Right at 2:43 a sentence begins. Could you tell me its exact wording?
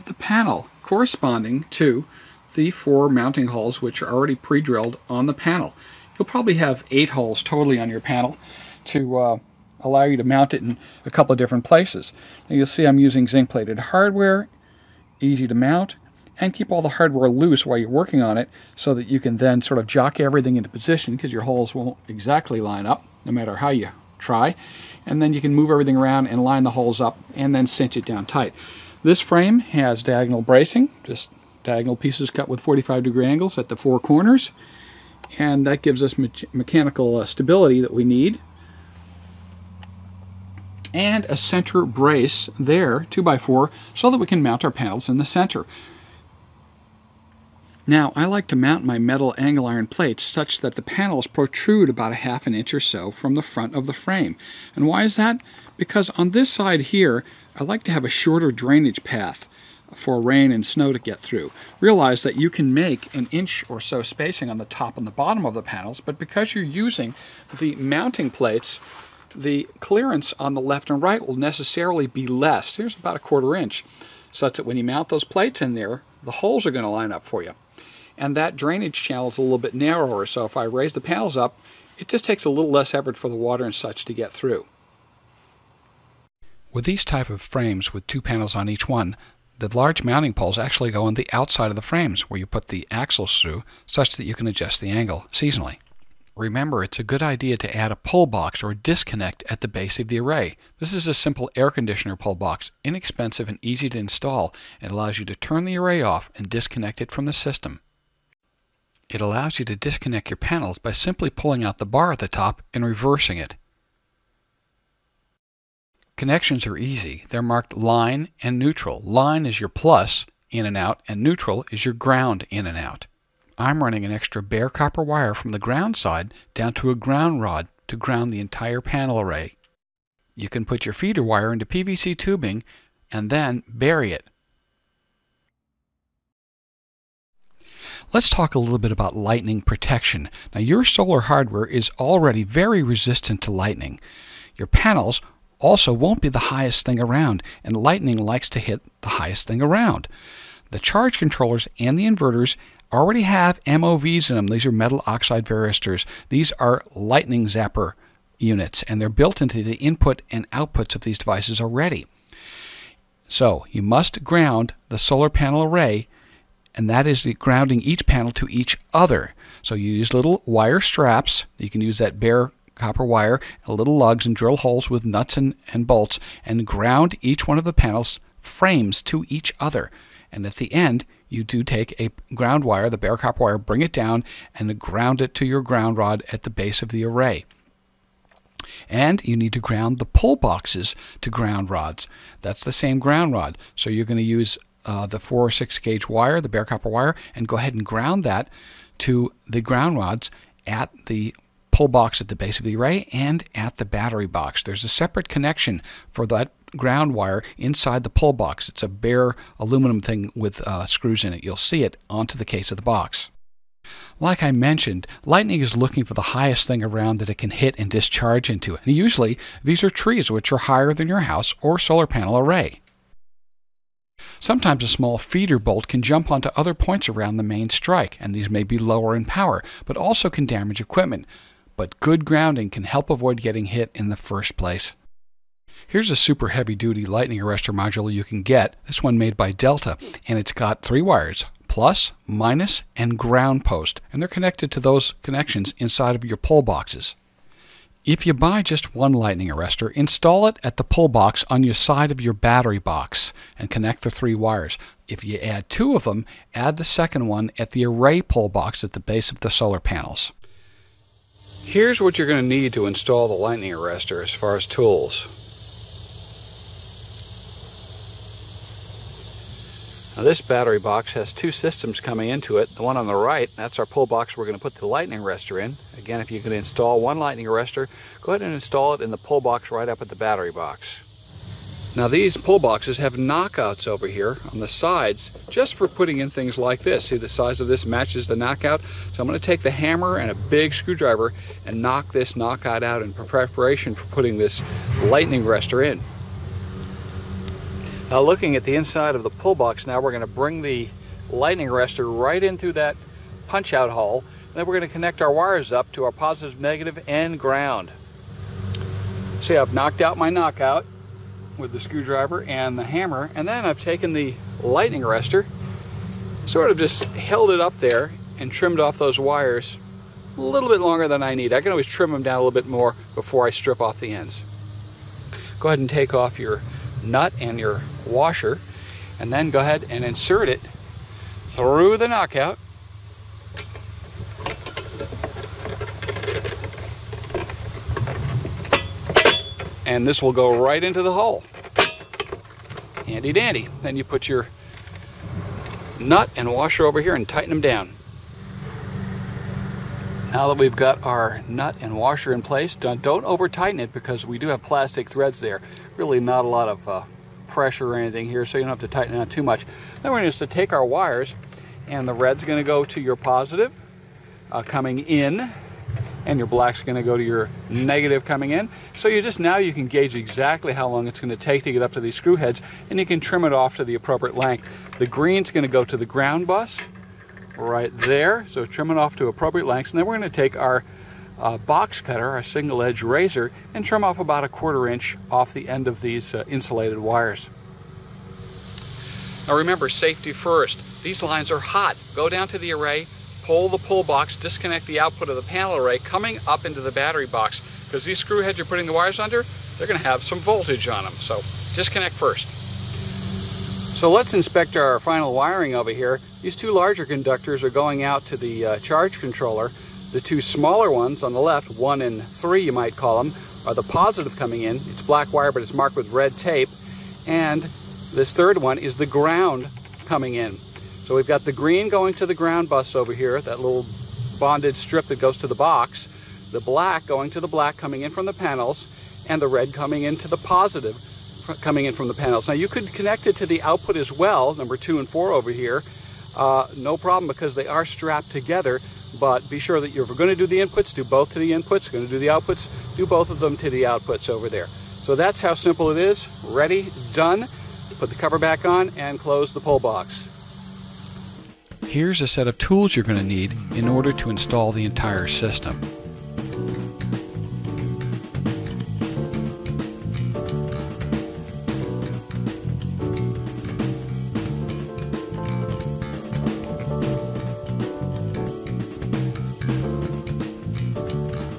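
So you must ground the solar panel array, and that is grounding each panel to each other.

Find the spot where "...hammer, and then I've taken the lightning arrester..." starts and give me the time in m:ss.
5:12.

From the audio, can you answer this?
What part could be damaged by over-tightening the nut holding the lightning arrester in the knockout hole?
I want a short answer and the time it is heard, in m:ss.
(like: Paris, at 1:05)
plastic threads, at 5:54.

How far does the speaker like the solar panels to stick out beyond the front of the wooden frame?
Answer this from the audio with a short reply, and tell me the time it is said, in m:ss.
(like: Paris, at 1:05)
half an inch, at 0:52.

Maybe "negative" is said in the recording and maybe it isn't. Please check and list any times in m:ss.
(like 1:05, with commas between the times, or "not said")
5:06, 6:07.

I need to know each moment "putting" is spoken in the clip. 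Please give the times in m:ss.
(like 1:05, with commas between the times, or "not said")
4:45, 4:54, 6:38.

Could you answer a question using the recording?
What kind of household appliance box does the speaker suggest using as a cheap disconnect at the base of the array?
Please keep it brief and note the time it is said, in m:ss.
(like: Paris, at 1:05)
air conditioner pull box, at 1:41.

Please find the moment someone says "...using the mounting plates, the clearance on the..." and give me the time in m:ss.
1:06.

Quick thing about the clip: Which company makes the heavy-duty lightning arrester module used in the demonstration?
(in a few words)
Delta.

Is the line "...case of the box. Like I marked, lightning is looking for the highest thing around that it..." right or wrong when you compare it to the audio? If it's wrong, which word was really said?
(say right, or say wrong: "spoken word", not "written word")
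wrong: "mentioned", not "marked".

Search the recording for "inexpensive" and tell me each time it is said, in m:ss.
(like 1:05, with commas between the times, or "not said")
1:42.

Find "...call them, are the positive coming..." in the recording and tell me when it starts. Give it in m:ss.
6:52.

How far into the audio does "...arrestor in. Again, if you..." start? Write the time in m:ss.
4:35.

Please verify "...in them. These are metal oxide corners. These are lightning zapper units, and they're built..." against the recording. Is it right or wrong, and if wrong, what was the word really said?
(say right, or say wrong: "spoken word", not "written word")
wrong: "varistors", not "corners".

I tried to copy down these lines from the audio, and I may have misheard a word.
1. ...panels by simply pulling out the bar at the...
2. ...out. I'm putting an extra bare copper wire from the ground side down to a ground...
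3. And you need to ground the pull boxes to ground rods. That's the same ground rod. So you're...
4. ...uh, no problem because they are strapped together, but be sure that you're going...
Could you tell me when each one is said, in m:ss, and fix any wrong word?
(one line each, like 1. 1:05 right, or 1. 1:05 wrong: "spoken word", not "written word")
1. 1:50 right
2. 2:02 wrong: "running", not "putting"
3. 3:08 right
4. 7:16 right.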